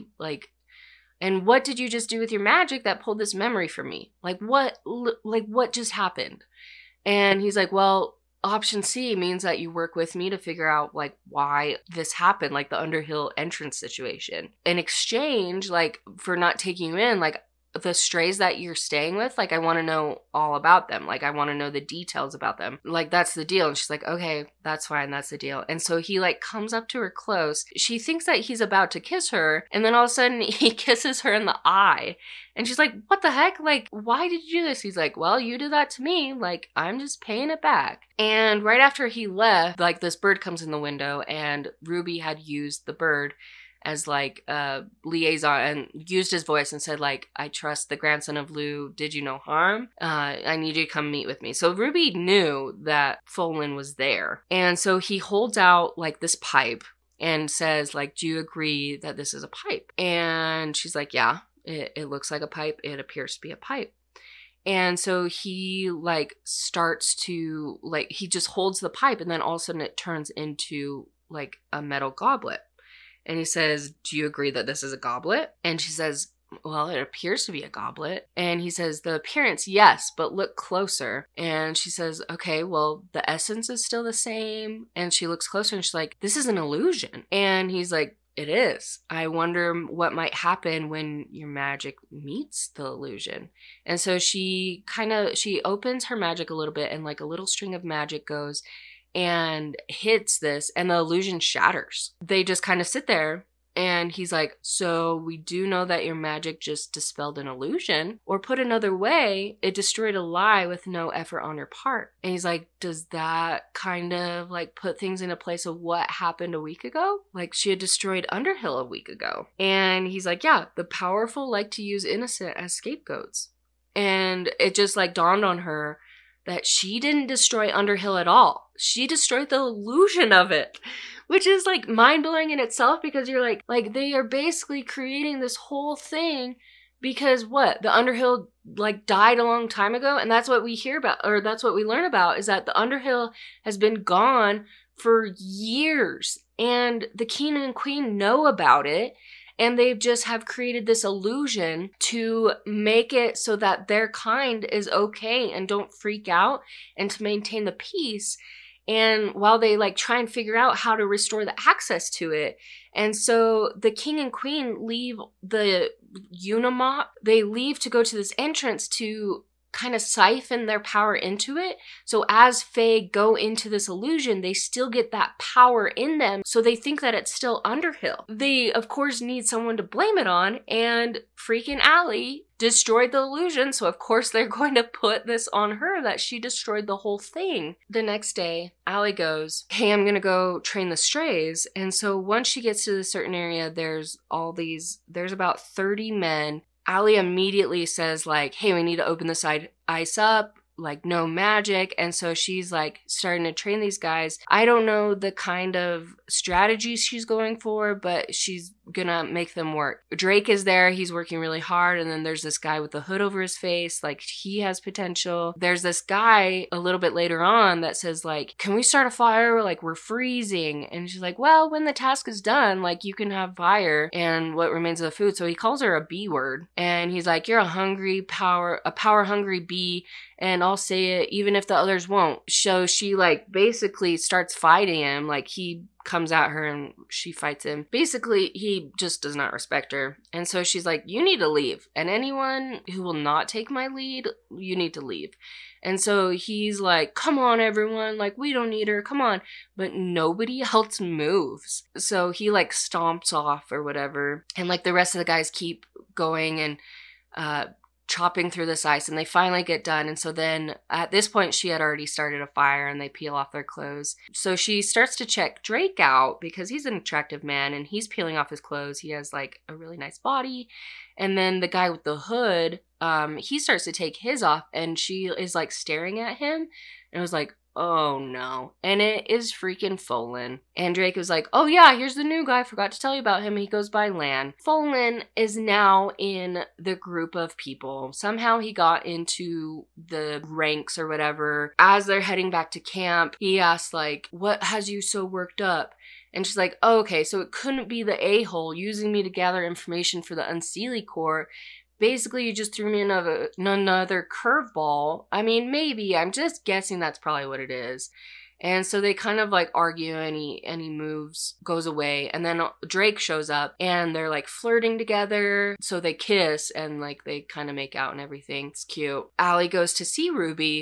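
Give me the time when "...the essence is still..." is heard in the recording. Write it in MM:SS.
01:23.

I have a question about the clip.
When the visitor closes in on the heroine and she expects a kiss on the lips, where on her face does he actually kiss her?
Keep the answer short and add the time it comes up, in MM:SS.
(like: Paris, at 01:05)
In the eye, at 00:31.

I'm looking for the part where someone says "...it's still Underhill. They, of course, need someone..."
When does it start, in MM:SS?
02:57.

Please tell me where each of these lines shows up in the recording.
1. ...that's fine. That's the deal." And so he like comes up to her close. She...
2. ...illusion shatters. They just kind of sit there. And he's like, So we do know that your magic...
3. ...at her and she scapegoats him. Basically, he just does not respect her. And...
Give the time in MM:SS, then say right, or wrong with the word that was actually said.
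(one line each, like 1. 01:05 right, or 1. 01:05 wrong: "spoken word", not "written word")
1. 00:24 right
2. 01:40 right
3. 03:56 wrong: "fights", not "scapegoats".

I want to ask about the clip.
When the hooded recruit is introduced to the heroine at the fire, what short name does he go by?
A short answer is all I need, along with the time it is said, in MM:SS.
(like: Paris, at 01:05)
Lan, at 04:44.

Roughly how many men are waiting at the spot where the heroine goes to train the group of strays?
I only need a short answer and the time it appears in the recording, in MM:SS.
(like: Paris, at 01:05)
30, at 03:15.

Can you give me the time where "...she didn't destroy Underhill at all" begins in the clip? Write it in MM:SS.
02:06.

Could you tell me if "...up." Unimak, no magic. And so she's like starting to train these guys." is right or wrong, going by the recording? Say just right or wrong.
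wrong.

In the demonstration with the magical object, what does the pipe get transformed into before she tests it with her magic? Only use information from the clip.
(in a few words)
A metal goblet.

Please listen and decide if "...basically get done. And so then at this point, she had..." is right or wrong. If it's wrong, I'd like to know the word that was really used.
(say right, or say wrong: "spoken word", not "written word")
wrong: "finally", not "basically".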